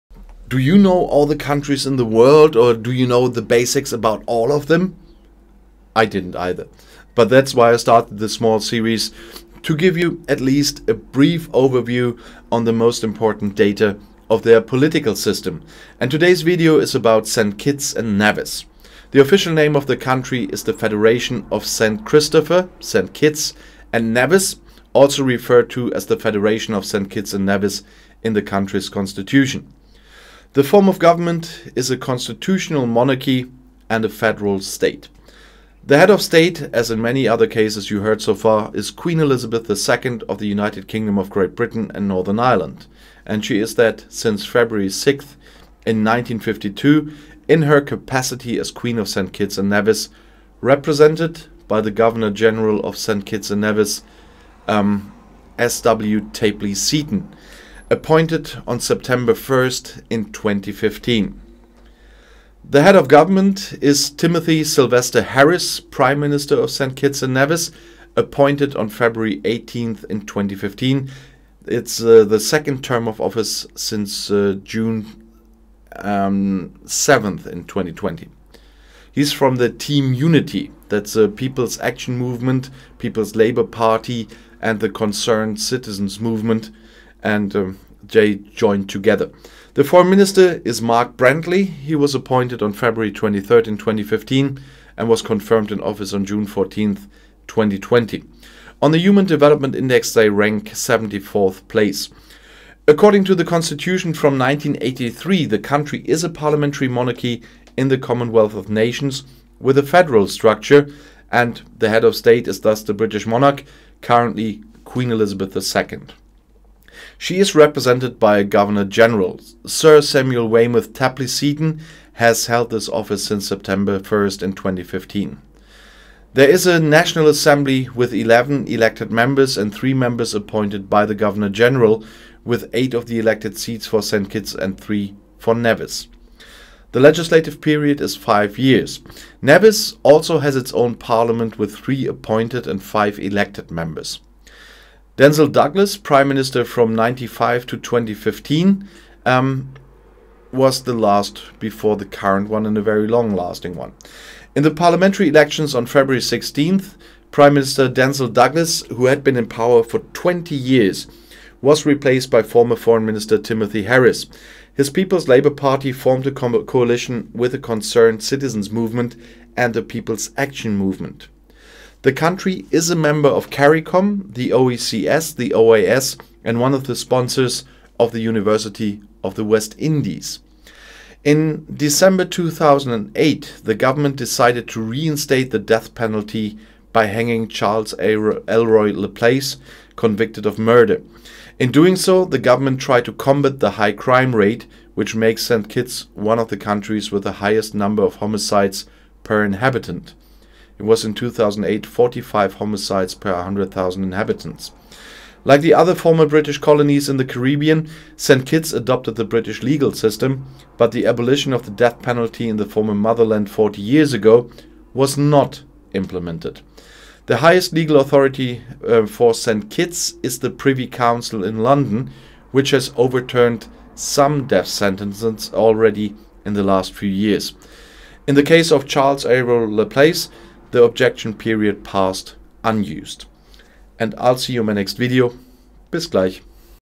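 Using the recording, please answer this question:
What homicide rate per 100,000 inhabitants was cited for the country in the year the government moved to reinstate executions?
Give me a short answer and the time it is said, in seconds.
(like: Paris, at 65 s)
45, at 201 s.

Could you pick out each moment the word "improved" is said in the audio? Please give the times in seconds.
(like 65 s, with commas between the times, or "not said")
not said.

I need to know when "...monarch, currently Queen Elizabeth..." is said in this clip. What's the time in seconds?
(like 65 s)
113 s.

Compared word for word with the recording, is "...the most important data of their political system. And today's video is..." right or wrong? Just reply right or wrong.
right.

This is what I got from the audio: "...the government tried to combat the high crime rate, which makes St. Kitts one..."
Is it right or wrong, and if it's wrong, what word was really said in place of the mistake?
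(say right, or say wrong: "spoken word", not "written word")
right.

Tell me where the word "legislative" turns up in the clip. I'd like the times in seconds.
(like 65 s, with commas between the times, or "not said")
136 s.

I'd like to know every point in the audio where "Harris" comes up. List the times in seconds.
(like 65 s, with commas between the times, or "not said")
65 s, 163 s.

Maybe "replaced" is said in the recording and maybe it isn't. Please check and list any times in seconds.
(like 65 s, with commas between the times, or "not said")
161 s.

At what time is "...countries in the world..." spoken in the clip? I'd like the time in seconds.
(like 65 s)
1 s.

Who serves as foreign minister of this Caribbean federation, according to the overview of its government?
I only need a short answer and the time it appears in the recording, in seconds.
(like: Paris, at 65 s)
Mark Brantley, at 90 s.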